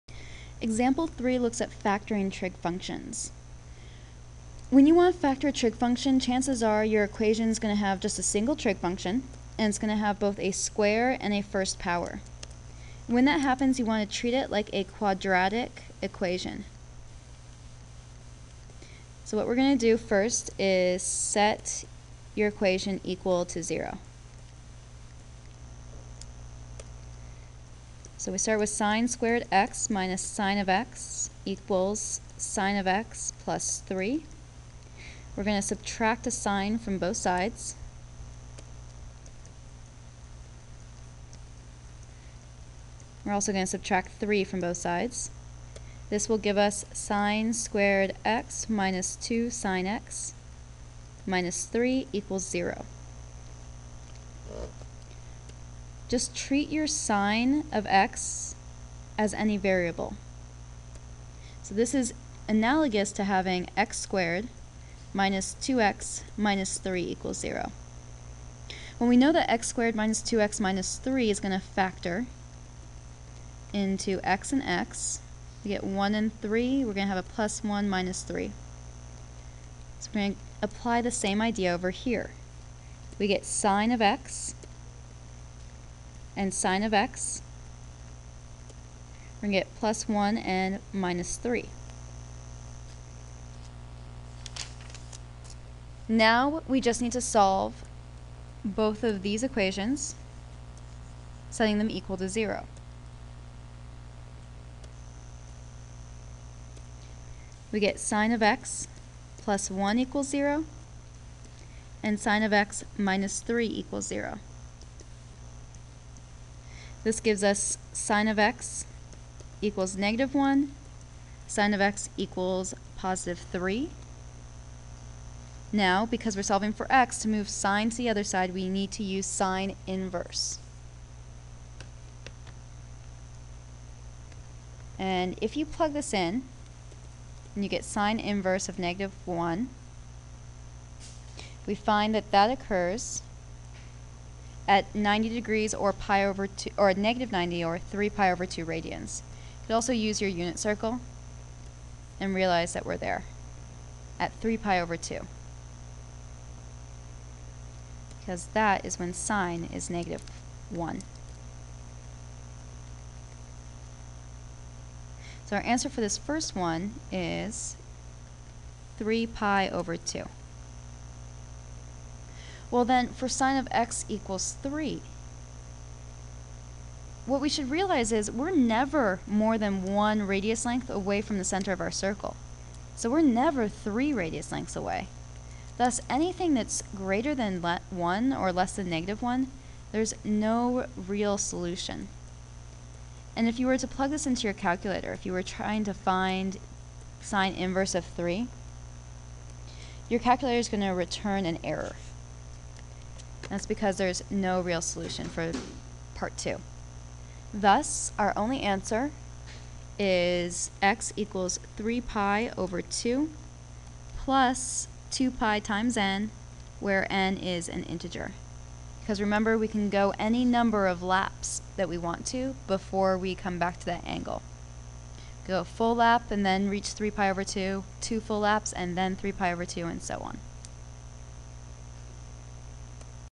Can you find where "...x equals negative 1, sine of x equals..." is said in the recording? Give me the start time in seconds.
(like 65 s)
118 s.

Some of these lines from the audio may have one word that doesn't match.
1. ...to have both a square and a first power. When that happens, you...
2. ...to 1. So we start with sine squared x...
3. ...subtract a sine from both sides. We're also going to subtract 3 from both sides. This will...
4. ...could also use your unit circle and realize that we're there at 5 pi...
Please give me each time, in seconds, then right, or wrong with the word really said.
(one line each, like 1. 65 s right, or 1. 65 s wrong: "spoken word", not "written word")
1. 9 s right
2. 23 s wrong: "0", not "1"
3. 35 s right
4. 149 s wrong: "3", not "5".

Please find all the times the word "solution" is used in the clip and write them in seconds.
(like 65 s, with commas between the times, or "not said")
191 s, 204 s.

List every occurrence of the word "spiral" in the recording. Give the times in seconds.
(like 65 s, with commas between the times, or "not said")
not said.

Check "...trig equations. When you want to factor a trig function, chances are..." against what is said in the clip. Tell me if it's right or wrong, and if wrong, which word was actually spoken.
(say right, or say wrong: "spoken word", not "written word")
wrong: "functions", not "equations".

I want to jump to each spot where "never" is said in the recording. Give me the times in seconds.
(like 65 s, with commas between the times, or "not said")
178 s, 183 s.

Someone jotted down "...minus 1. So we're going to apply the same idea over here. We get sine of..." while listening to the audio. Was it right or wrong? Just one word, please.
wrong.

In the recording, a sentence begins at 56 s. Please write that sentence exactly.
just treat your sine of x as any variable.